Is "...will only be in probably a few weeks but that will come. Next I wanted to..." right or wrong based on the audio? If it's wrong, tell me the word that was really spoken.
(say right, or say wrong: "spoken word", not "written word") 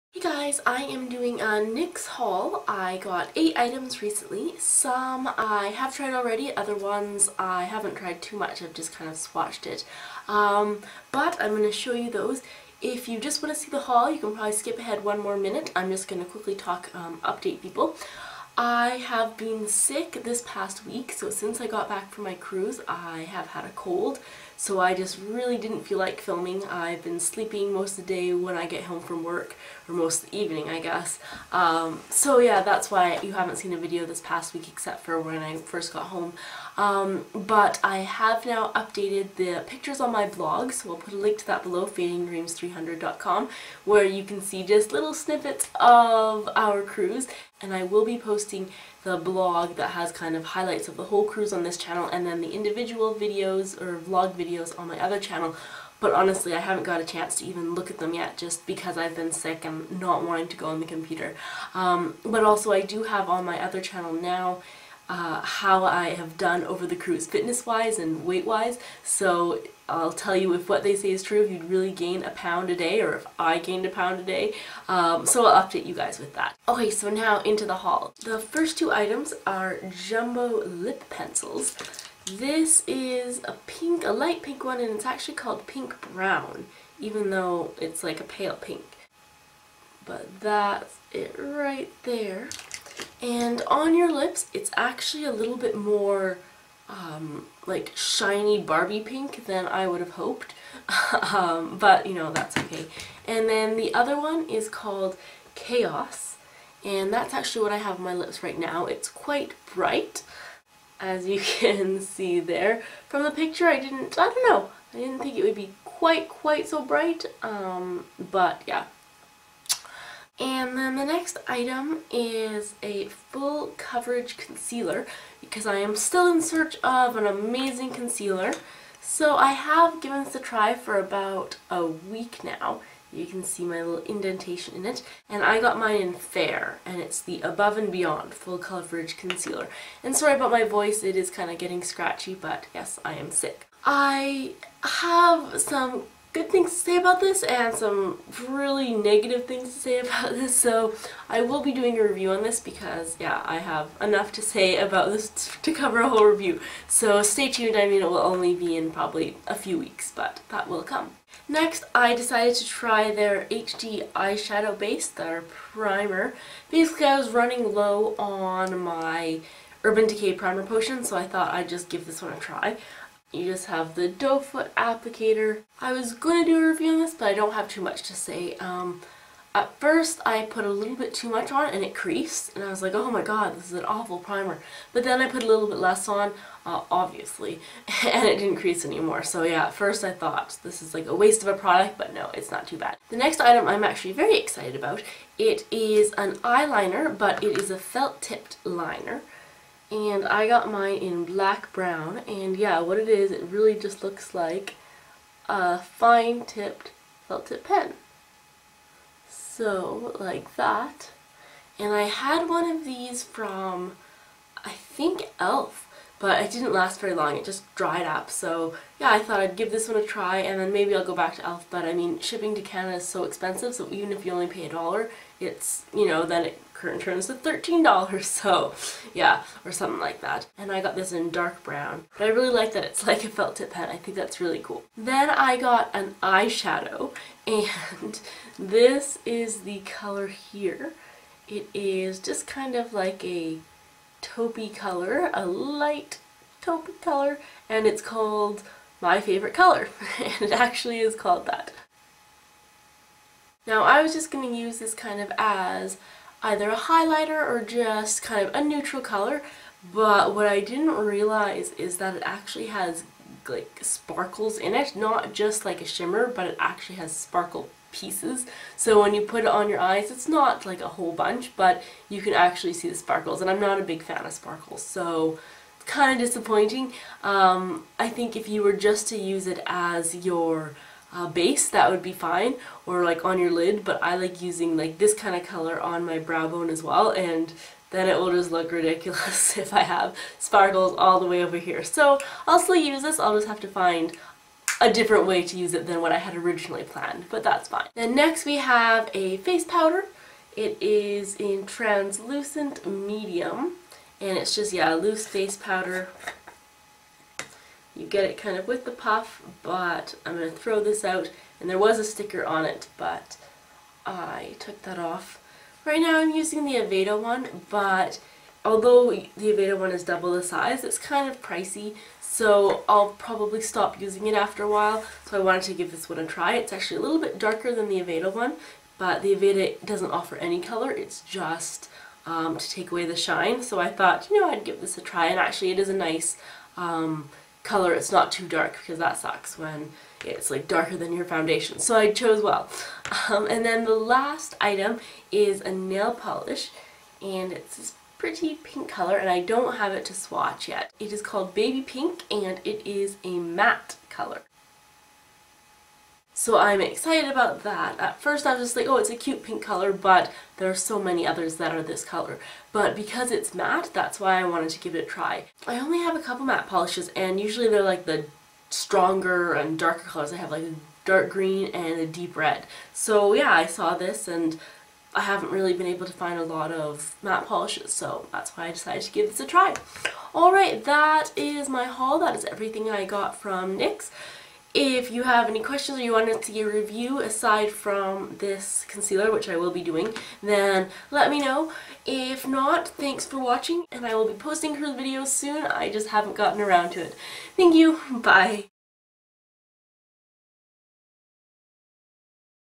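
wrong: "decided", not "wanted".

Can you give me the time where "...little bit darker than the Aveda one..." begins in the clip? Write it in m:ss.
5:27.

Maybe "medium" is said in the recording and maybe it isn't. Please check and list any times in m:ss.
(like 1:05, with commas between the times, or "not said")
5:02.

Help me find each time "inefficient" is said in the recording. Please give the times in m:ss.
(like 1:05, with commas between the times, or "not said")
not said.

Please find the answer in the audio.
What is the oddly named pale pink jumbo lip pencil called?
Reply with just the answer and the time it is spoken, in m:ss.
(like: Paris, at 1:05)
Pink Brown, at 1:25.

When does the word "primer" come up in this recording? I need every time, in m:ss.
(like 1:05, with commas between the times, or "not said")
2:45, 2:50, 3:04.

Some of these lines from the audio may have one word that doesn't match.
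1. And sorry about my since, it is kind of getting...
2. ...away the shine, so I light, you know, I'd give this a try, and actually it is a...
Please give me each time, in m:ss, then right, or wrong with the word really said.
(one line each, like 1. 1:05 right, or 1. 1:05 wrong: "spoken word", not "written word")
1. 2:20 wrong: "voice", not "since"
2. 5:32 wrong: "thought", not "light".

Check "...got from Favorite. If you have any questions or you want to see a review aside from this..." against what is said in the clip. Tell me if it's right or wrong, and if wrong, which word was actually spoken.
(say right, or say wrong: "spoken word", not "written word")
wrong: "NYX", not "Favorite".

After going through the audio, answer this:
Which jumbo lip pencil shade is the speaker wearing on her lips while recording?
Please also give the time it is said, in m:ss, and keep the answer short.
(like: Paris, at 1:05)
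Chaos, at 1:45.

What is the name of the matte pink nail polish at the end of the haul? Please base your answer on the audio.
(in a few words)
Baby Pink.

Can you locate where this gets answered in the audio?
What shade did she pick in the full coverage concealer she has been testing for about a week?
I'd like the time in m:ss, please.
2:16.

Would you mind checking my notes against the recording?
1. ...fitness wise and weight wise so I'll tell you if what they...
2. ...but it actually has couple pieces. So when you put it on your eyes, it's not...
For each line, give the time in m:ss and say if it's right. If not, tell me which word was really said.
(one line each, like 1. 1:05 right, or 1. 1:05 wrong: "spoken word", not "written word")
1. 1:07 right
2. 4:26 wrong: "sparkle", not "couple".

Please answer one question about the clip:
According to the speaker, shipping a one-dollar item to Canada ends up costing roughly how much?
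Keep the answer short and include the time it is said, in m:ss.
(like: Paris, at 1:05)
$13, at 3:47.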